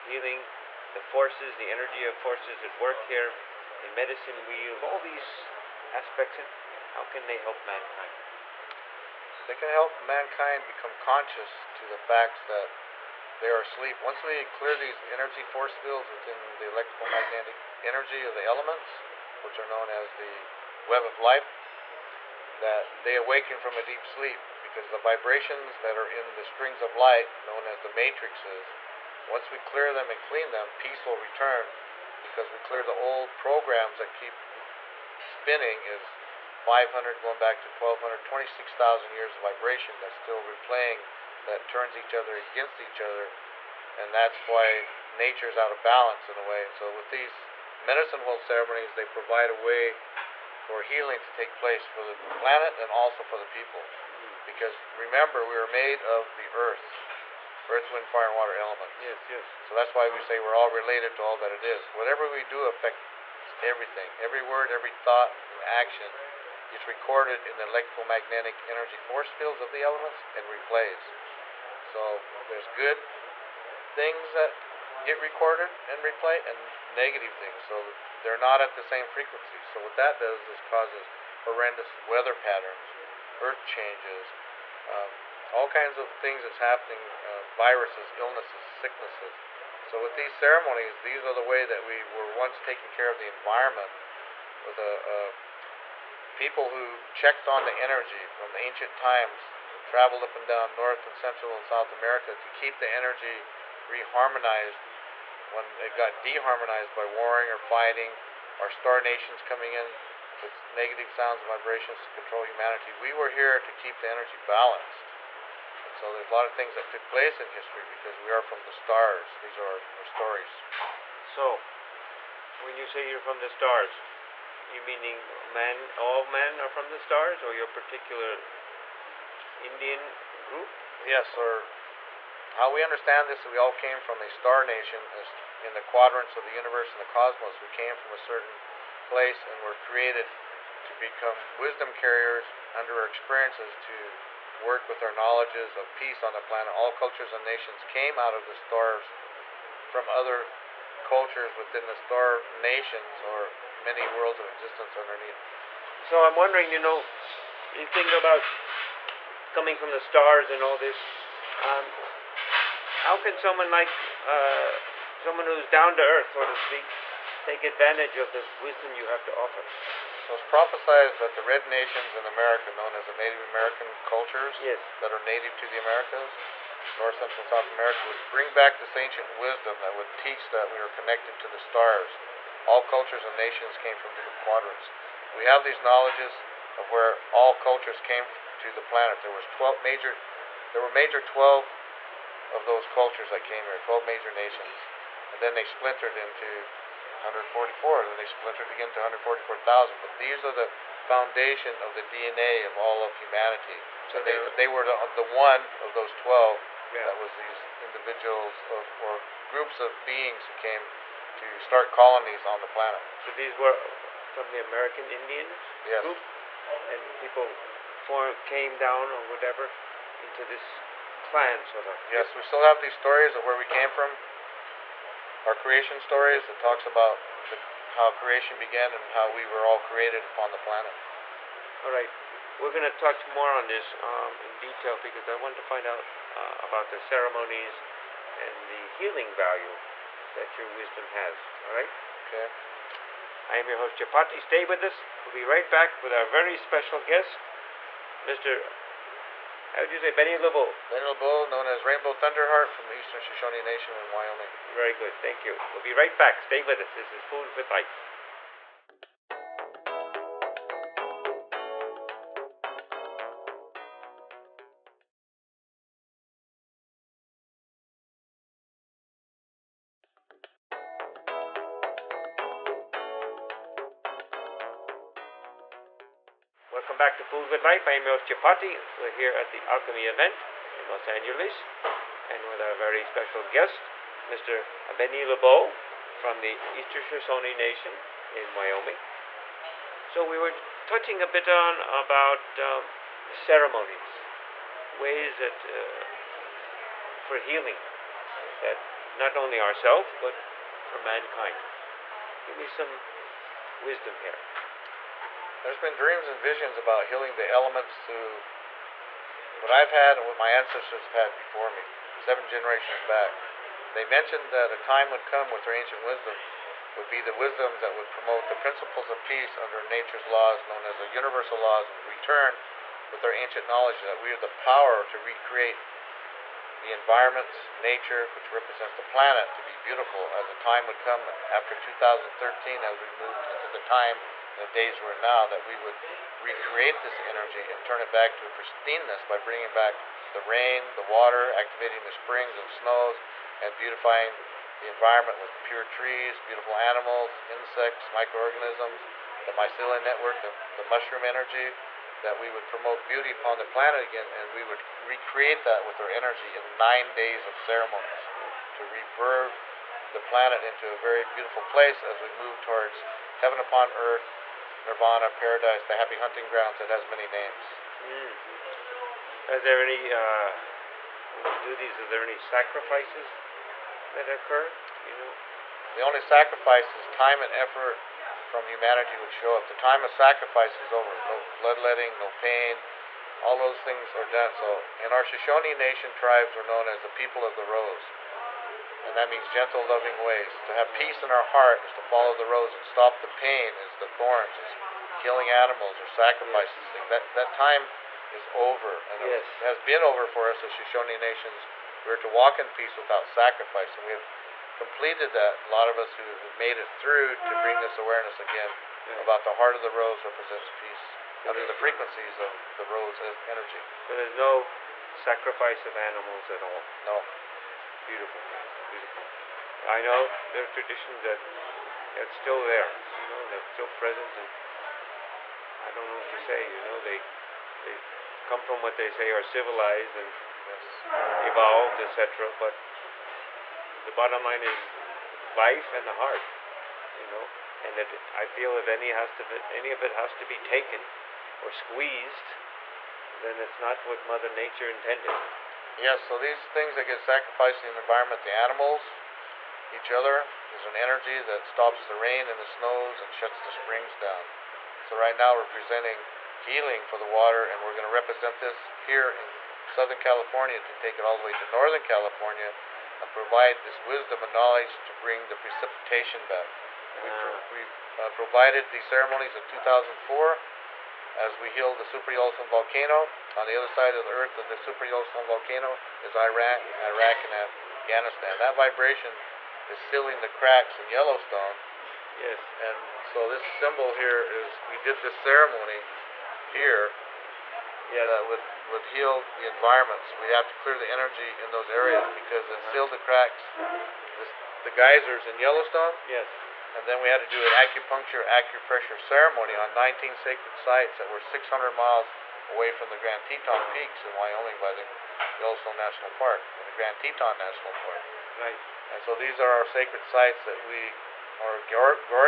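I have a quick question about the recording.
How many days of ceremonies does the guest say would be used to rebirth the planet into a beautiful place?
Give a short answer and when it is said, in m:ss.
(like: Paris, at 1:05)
9, at 5:56.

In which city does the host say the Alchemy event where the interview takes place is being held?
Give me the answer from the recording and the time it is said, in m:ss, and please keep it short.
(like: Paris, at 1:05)
Los Angeles, at 4:40.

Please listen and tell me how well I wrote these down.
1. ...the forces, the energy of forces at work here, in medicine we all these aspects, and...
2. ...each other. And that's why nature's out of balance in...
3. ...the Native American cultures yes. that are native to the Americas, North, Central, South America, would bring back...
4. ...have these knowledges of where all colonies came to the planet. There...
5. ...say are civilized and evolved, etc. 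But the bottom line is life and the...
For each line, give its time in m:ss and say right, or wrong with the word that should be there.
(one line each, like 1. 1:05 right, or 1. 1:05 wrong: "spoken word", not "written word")
1. 0:00 right
2. 0:42 right
3. 2:53 right
4. 3:05 wrong: "cultures", not "colonies"
5. 7:09 right.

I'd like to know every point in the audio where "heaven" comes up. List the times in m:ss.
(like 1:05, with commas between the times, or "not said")
6:03.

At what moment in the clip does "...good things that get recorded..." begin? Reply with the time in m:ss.
1:12.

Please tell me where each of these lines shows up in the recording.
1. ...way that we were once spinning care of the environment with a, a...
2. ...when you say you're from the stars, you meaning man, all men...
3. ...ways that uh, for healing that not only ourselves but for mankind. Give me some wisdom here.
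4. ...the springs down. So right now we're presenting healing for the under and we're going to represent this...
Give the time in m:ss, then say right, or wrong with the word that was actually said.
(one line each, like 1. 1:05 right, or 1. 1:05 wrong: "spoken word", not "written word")
1. 1:31 wrong: "taking", not "spinning"
2. 2:02 right
3. 4:54 right
4. 7:33 wrong: "water", not "under".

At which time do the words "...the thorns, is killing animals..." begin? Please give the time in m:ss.
6:33.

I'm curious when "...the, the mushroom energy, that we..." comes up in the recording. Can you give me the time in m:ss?
5:50.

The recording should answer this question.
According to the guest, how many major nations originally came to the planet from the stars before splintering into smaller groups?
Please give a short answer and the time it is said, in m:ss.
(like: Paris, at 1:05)
12, at 3:13.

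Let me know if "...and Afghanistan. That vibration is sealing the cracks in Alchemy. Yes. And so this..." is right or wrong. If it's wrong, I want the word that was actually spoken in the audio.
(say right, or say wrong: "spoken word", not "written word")
wrong: "Yellowstone", not "Alchemy".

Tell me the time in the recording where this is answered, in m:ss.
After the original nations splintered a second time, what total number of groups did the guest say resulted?
3:18.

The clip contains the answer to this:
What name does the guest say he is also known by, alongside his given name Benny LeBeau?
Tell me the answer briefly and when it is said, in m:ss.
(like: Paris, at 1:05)
Rainbow Thunderheart, at 4:11.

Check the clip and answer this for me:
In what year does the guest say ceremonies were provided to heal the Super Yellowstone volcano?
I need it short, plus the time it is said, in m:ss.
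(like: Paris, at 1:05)
2004, at 7:49.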